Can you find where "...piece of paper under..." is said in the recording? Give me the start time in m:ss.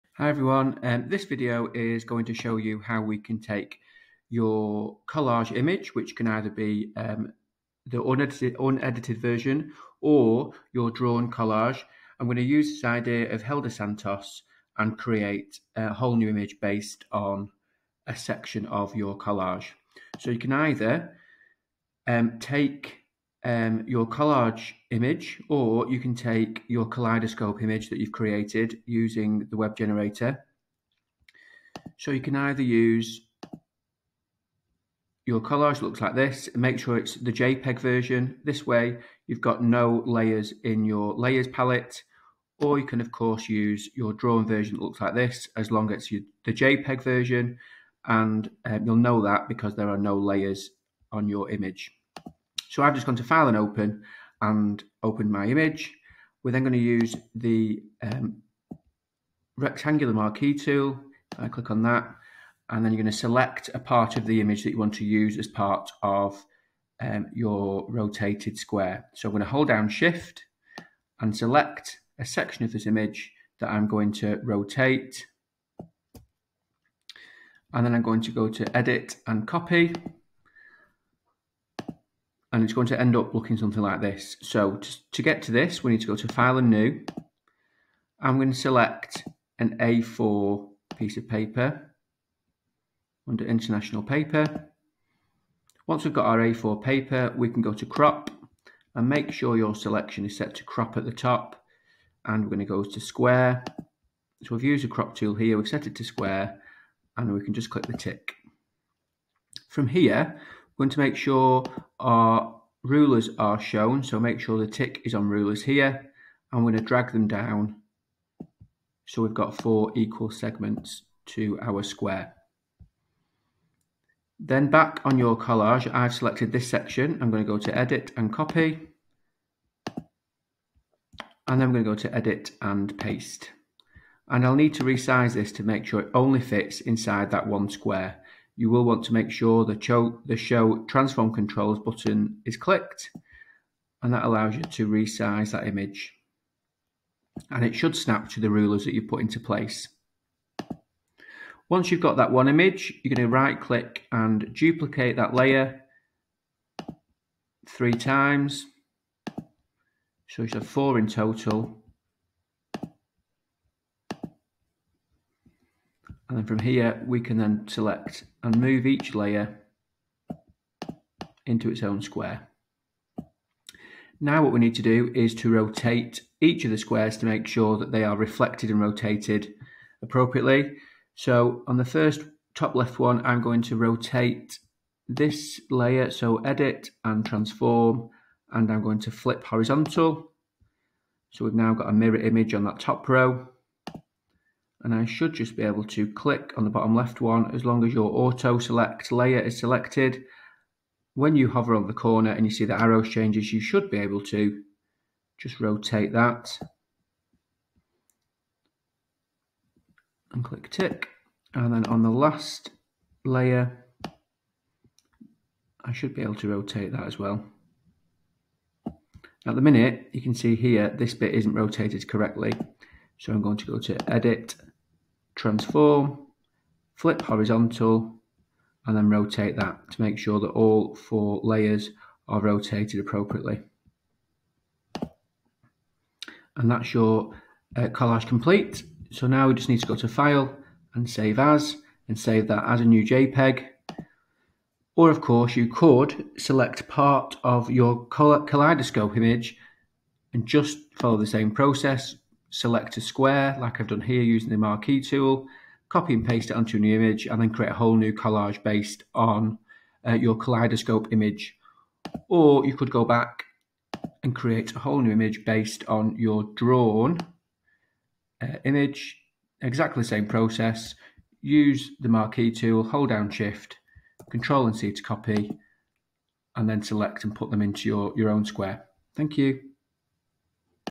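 1:30.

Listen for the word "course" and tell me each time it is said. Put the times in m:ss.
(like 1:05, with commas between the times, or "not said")
0:43, 4:05.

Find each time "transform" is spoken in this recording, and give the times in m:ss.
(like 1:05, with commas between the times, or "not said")
2:20, 3:07, 3:45.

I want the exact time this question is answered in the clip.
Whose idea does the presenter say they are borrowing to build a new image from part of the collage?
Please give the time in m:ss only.
0:13.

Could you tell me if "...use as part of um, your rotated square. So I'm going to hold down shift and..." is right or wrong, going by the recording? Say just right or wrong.
right.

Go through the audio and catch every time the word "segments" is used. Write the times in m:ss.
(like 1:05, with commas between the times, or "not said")
2:00.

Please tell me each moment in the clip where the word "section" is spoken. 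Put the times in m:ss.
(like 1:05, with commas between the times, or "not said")
0:18, 1:12, 2:06.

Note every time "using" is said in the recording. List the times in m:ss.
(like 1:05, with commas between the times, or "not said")
0:28, 4:14.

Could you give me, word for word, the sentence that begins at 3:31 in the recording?
And then on the last layer, I should be able to rotate that as well.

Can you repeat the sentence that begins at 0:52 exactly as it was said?
So I've just gone to File and Open and opened my image.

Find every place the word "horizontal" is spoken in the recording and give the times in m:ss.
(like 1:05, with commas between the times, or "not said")
3:09, 3:47.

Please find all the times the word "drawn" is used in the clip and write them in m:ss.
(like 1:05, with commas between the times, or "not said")
0:10, 0:44, 4:26.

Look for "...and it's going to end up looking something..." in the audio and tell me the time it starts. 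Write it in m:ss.
1:22.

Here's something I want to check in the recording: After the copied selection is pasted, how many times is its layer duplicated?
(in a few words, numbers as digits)
3.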